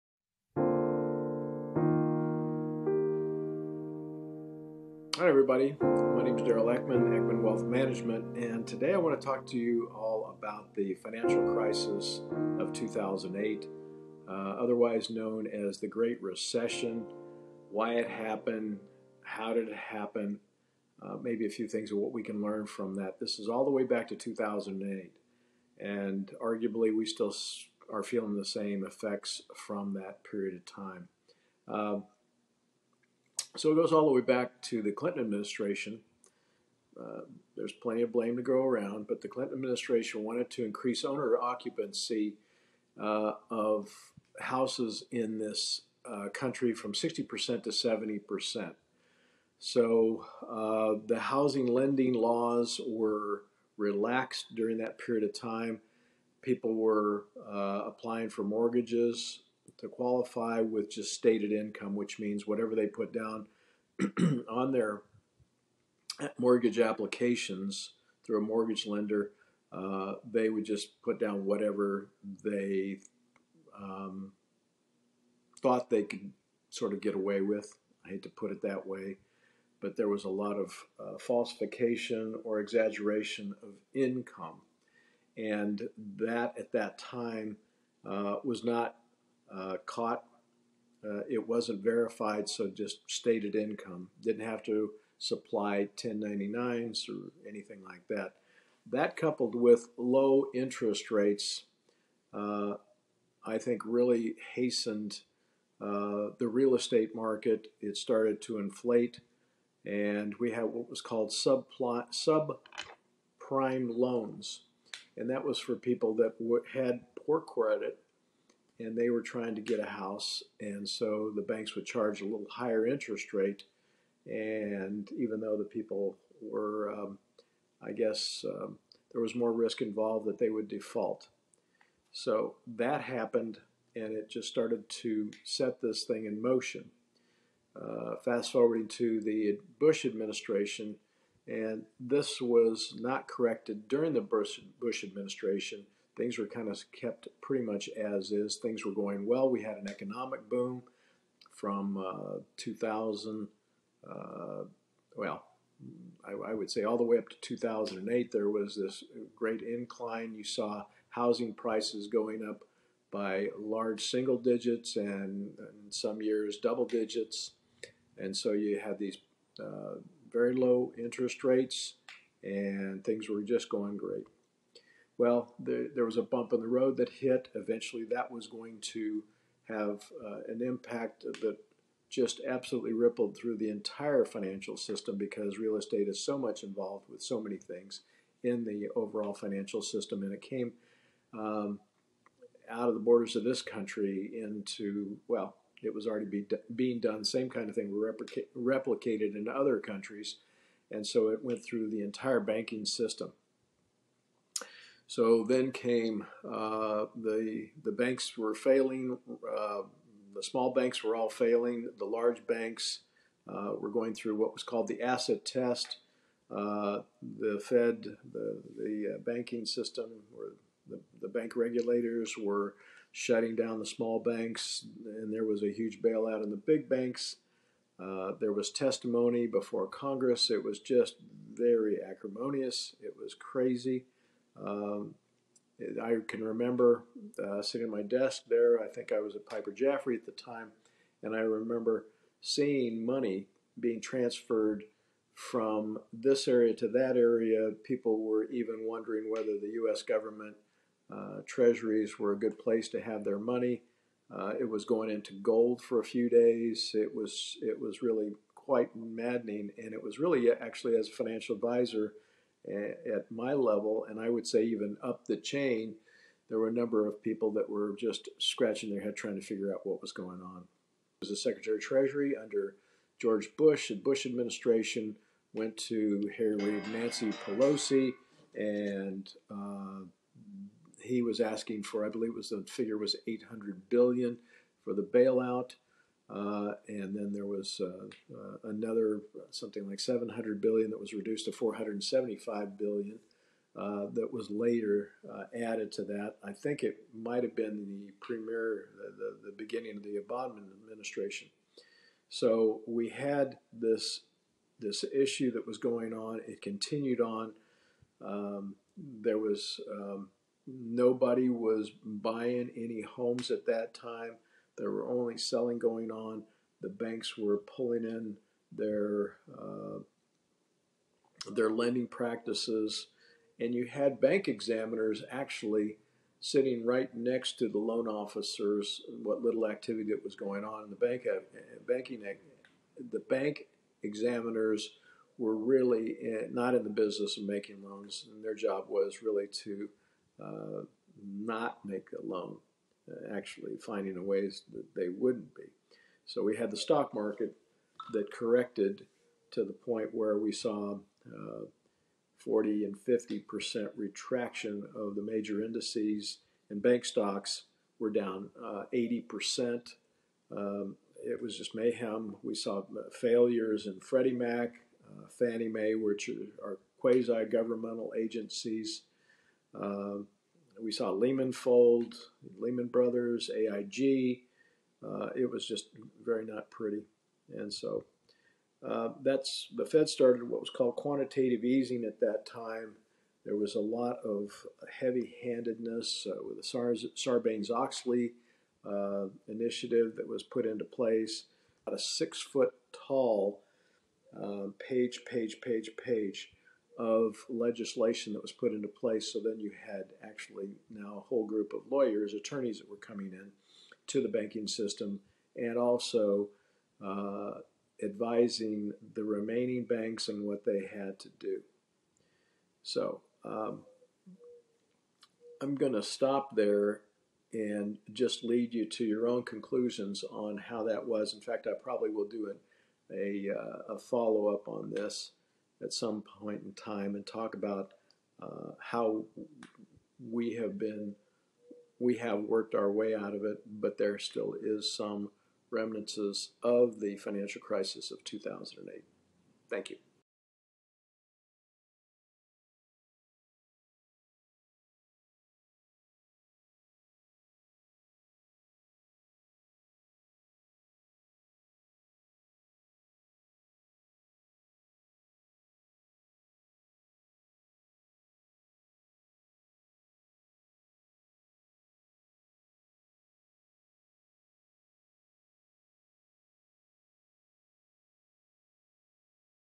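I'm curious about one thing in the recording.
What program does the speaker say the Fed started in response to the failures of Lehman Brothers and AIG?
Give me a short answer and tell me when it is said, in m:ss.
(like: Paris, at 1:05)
quantitative easing, at 6:20.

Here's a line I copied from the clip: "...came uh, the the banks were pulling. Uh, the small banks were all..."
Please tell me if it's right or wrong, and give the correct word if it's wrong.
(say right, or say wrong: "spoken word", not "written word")
wrong: "failing", not "pulling".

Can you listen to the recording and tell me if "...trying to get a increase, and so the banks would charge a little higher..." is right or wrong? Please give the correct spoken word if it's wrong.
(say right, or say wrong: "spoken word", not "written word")
wrong: "house", not "increase".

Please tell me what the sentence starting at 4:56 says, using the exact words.
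I think it might have been the premier, the, the, the beginning of the Obama administration.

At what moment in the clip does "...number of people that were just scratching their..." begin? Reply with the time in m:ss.
4:26.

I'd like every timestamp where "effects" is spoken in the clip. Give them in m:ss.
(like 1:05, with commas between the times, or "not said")
0:28.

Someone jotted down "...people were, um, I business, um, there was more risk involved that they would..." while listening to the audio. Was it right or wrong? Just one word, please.
wrong.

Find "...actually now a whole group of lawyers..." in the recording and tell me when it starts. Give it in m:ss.
6:40.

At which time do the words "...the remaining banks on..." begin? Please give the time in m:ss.
6:49.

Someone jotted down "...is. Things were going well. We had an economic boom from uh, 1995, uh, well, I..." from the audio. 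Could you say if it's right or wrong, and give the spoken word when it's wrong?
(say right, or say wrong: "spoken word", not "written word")
wrong: "2000", not "1995".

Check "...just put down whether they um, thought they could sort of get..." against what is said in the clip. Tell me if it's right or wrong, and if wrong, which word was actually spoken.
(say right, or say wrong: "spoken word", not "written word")
wrong: "whatever", not "whether".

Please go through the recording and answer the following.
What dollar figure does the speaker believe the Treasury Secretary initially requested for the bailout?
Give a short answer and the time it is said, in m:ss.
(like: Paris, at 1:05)
800 billion, at 4:43.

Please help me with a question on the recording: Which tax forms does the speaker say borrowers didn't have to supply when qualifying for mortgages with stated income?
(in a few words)
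1099s.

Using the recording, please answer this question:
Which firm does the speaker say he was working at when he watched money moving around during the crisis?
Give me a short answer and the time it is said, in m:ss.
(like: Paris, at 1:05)
Piper Jaffray, at 3:59.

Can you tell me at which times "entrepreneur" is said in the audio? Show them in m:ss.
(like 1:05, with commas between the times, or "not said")
not said.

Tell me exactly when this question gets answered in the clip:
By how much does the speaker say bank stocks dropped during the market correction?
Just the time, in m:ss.
5:58.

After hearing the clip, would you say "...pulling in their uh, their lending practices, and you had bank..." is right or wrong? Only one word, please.
right.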